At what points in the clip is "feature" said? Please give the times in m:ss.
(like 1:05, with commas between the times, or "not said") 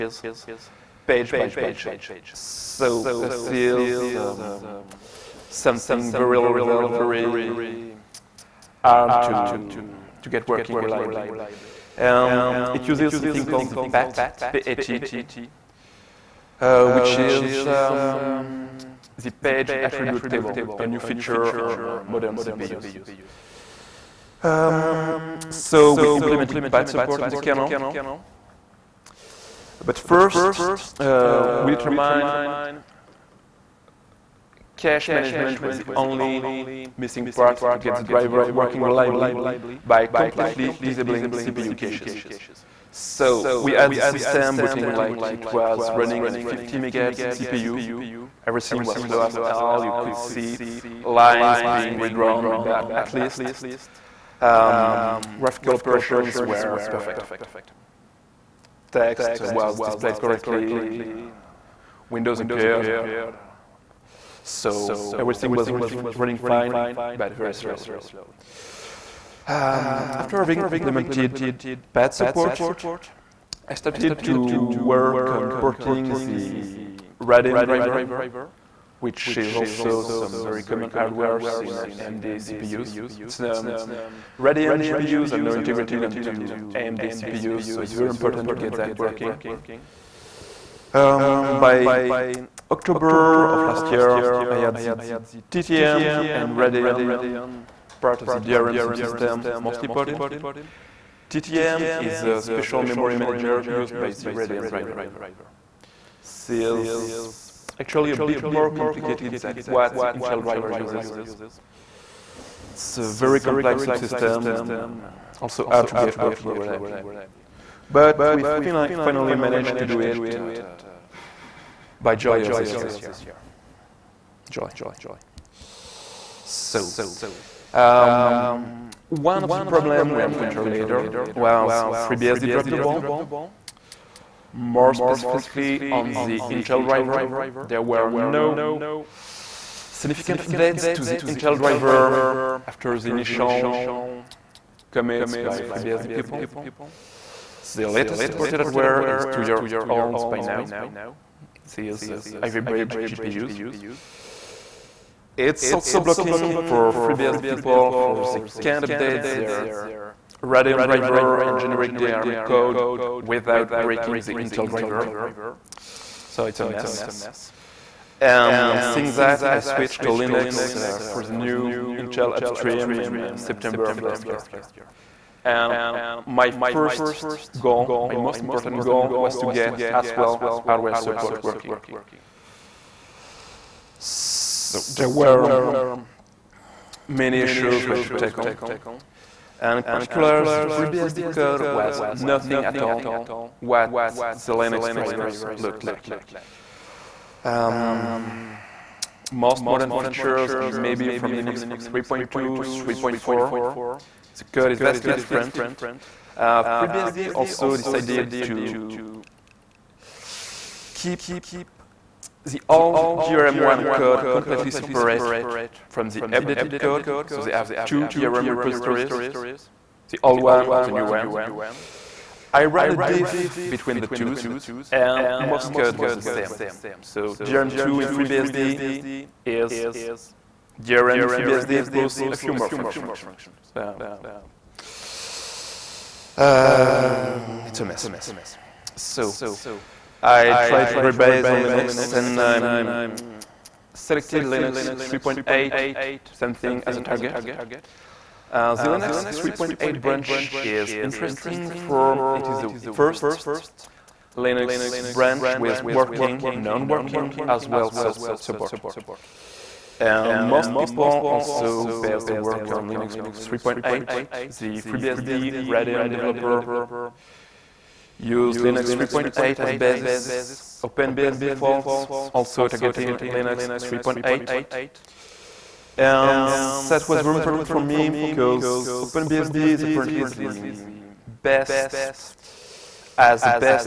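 0:20, 3:19.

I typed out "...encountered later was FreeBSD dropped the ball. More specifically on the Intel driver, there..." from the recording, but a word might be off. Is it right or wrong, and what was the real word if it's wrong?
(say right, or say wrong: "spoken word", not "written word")
right.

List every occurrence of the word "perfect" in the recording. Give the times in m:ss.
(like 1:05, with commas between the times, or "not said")
0:56.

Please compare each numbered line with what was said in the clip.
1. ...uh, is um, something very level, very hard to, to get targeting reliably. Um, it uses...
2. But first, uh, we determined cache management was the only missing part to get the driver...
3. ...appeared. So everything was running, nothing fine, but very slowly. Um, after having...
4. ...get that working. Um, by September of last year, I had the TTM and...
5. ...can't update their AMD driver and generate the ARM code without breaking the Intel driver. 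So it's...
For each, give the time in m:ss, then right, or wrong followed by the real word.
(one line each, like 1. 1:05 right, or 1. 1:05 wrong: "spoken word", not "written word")
1. 0:03 wrong: "working", not "targeting"
2. 0:29 right
3. 1:02 wrong: "running", not "nothing"
4. 1:28 wrong: "October", not "September"
5. 2:38 wrong: "Radeon", not "AMD".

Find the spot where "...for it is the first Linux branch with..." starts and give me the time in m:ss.
4:11.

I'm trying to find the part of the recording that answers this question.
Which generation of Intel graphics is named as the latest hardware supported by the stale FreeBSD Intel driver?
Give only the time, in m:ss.
2:32.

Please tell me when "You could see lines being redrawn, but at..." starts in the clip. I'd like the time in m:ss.
0:49.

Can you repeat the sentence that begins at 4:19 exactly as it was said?
Um, most people also base their work on Linux 3.8.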